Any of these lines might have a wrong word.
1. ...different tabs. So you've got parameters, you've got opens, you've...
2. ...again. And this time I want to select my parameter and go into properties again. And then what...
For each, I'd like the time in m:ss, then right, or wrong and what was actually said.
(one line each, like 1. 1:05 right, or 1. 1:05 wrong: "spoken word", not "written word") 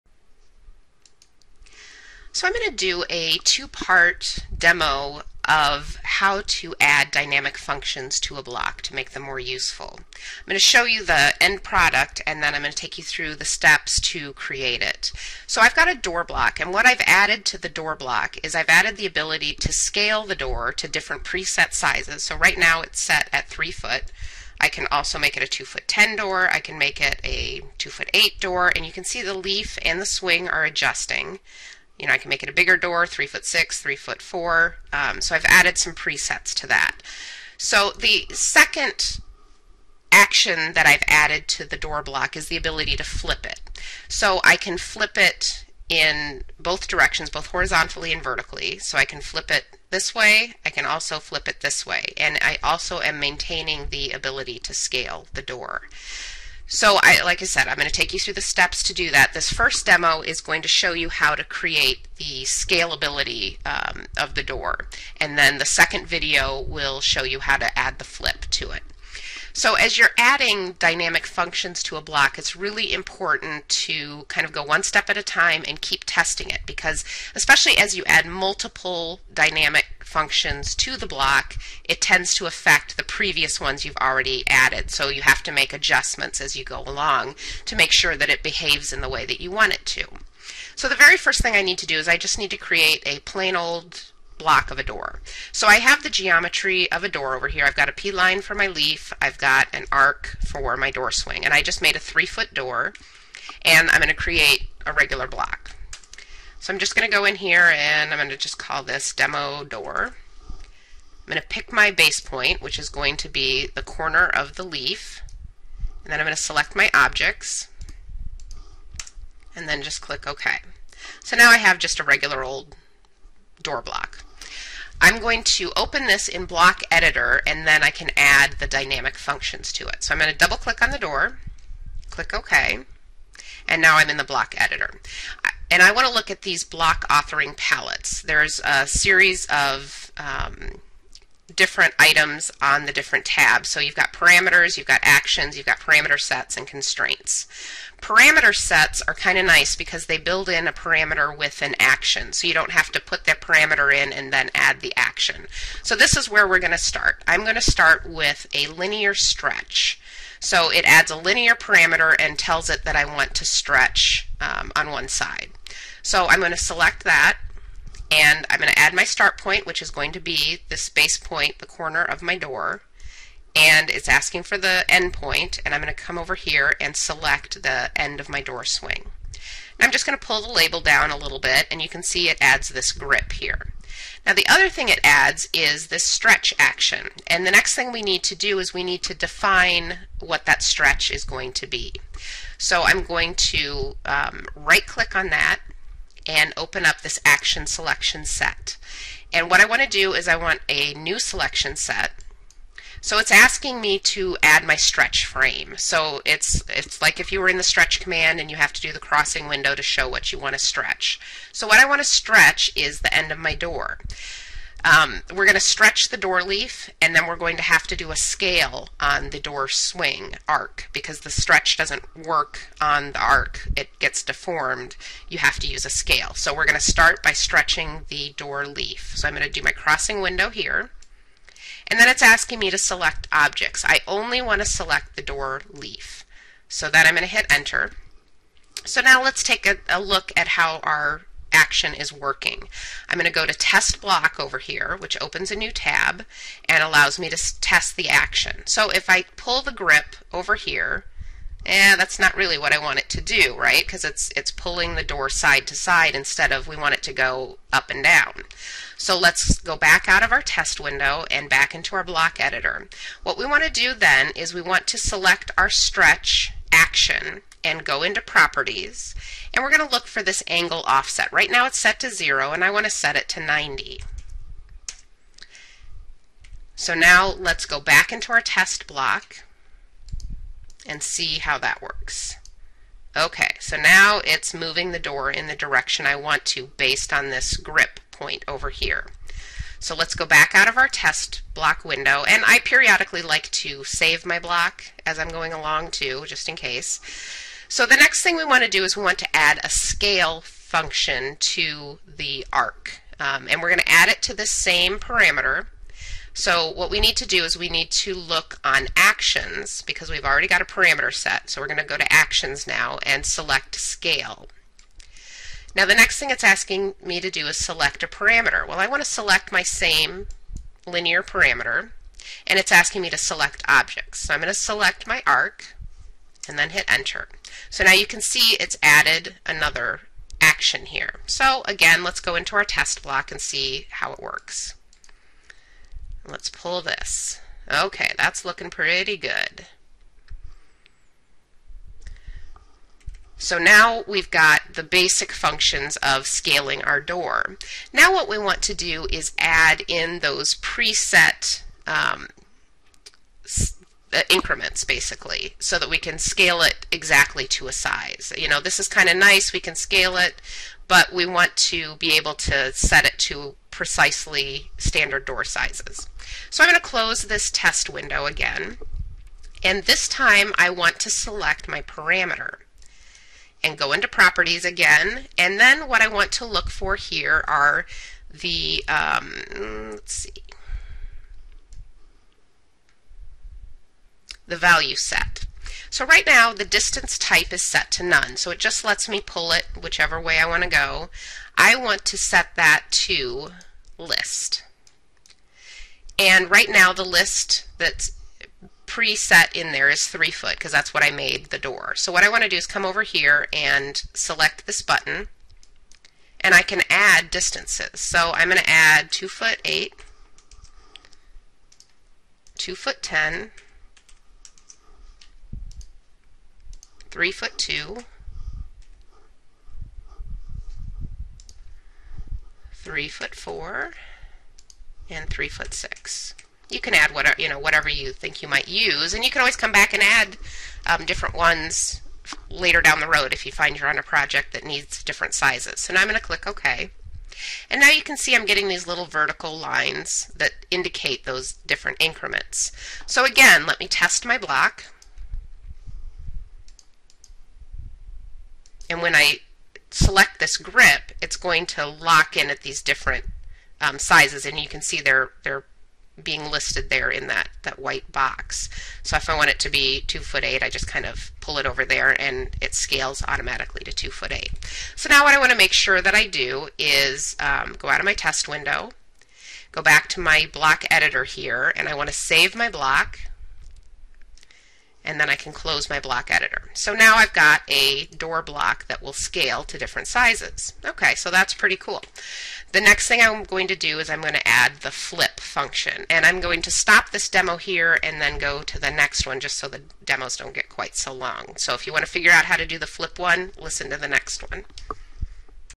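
1. 2:22 wrong: "actions", not "opens"
2. 6:08 right.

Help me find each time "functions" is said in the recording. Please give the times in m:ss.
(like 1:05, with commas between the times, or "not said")
0:07, 1:11, 1:20, 2:09, 5:00, 5:45, 8:05.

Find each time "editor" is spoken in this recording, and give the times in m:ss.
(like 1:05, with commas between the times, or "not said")
2:06, 2:14, 4:22, 7:50, 7:56.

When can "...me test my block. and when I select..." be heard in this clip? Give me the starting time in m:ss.
7:23.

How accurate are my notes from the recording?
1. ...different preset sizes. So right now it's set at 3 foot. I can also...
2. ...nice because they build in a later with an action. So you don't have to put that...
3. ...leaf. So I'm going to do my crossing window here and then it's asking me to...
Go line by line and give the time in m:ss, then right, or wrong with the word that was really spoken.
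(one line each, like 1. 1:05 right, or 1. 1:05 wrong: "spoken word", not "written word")
1. 0:20 right
2. 2:29 wrong: "parameter", not "later"
3. 3:48 right.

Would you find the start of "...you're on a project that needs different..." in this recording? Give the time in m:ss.
7:13.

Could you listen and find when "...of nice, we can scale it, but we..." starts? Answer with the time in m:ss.
5:59.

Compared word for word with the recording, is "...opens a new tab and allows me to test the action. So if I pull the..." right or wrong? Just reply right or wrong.
right.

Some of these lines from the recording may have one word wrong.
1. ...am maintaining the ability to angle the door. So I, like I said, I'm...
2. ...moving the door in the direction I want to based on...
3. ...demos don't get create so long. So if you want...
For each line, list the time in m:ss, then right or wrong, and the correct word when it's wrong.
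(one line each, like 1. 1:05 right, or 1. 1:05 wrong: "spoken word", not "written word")
1. 0:53 wrong: "scale", not "angle"
2. 4:44 right
3. 8:10 wrong: "quite", not "create".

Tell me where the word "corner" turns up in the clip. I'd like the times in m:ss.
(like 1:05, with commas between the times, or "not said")
1:53, 2:51.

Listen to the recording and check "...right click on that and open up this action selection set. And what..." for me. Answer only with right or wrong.
right.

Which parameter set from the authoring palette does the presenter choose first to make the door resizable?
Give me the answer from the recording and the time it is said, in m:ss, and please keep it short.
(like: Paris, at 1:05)
linear stretch, at 2:38.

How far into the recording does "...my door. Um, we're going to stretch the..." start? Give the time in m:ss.
3:33.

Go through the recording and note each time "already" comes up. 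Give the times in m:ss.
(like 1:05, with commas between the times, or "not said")
1:23, 5:10.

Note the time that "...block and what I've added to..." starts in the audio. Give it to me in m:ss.
0:16.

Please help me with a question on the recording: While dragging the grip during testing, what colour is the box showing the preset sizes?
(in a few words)
white.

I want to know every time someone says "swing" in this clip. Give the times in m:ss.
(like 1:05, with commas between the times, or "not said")
0:30, 1:41, 2:58, 3:39.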